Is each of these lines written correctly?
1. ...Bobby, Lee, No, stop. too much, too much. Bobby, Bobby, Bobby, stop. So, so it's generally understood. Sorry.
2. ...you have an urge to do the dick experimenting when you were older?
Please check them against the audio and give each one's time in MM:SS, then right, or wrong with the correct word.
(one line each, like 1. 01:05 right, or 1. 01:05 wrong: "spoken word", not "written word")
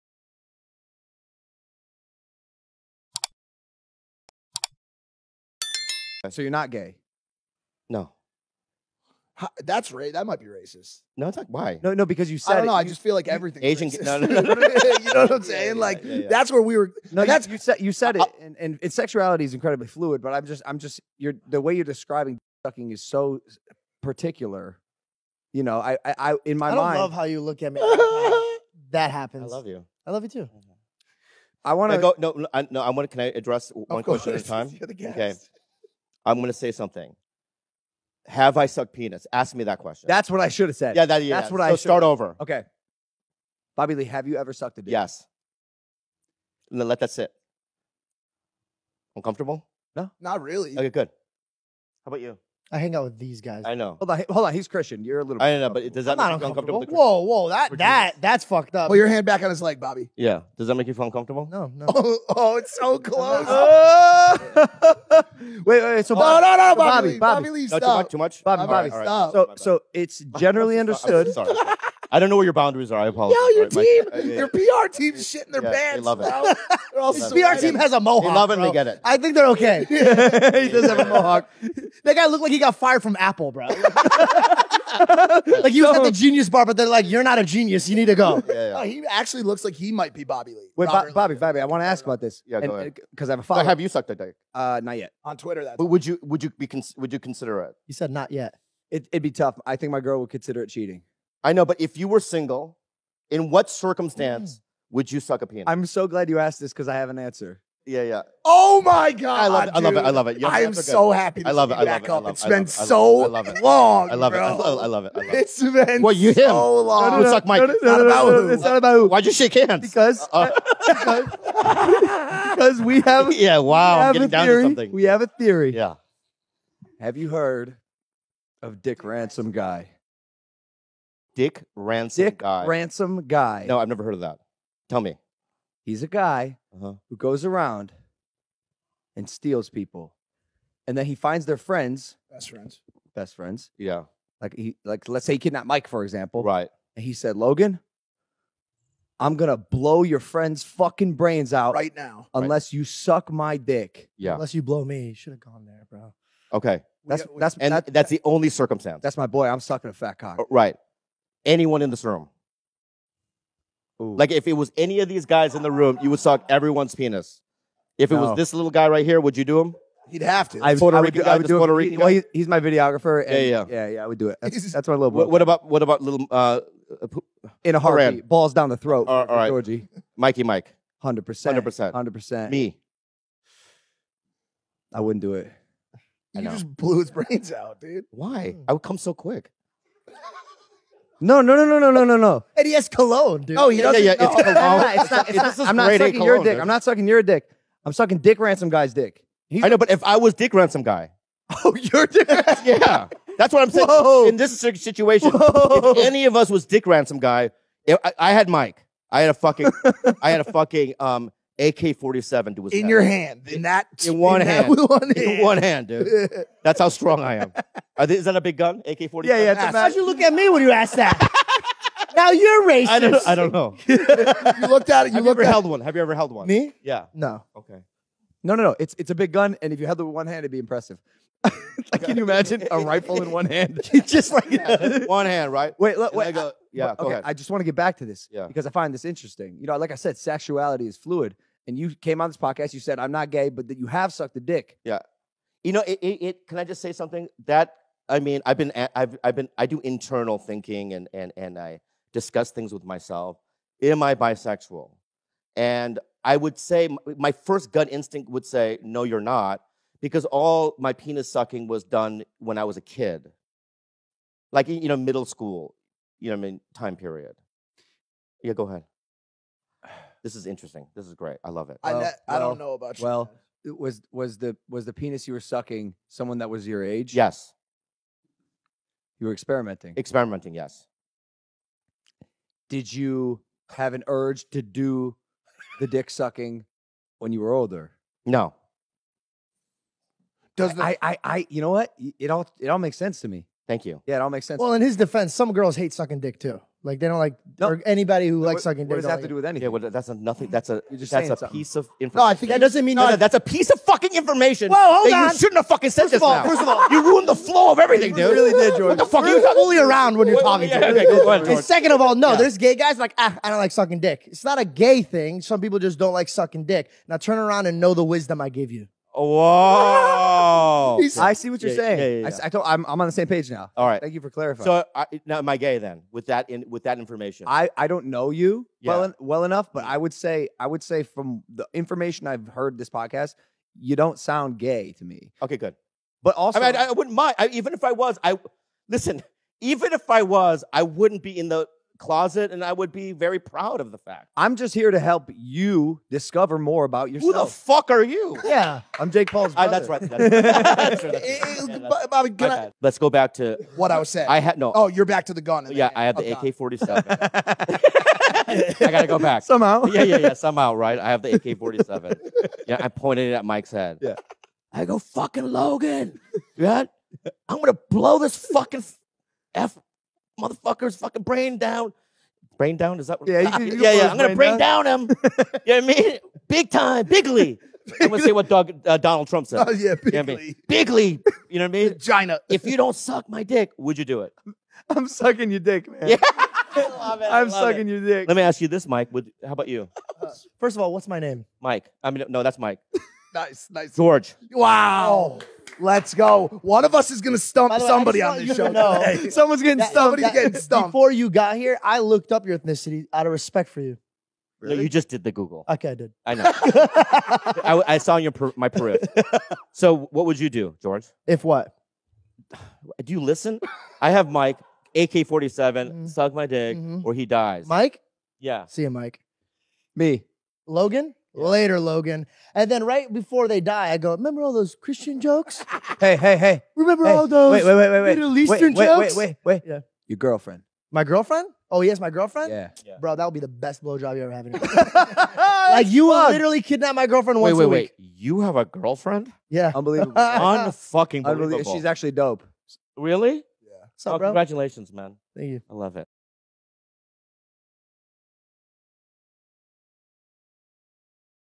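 1. 01:07 right
2. 04:42 wrong: "sucking", not "experimenting".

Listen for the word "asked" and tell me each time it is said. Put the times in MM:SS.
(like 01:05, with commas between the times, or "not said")
01:46, 03:40.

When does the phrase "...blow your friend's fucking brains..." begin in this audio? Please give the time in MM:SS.
02:29.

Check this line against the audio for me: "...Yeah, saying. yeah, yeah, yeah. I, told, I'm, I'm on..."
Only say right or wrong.
right.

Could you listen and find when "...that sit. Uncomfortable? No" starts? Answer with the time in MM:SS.
00:46.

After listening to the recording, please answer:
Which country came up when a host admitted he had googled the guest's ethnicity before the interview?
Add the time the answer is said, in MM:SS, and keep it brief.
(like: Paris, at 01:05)
Peru, at 06:48.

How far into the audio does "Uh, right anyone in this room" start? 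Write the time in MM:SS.
02:40.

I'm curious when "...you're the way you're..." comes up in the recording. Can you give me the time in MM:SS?
00:21.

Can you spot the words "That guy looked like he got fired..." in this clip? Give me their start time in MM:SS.
01:22.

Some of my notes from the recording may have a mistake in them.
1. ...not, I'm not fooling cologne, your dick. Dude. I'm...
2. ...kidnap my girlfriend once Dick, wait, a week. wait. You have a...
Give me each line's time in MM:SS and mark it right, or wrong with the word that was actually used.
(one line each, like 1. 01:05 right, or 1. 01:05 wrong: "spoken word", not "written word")
1. 03:15 wrong: "sucking", not "fooling"
2. 07:16 wrong: "Wait", not "Dick".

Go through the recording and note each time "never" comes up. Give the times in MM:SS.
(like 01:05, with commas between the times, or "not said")
02:13.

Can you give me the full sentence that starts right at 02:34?
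Unless you blow me, you should have gone there, bro.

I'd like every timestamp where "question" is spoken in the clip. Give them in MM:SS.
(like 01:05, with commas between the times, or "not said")
00:34, 00:39.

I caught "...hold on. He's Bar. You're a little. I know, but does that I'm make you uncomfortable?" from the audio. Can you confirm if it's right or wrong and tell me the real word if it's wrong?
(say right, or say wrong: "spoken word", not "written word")
wrong: "Christian", not "Bar".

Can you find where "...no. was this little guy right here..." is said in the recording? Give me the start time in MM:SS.
02:48.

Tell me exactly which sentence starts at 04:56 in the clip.
Like they don't like or anybody who no, likes sucking dick.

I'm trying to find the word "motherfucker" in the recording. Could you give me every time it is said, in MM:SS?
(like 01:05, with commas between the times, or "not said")
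06:10.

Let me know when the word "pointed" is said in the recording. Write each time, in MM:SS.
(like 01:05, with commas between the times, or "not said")
06:02.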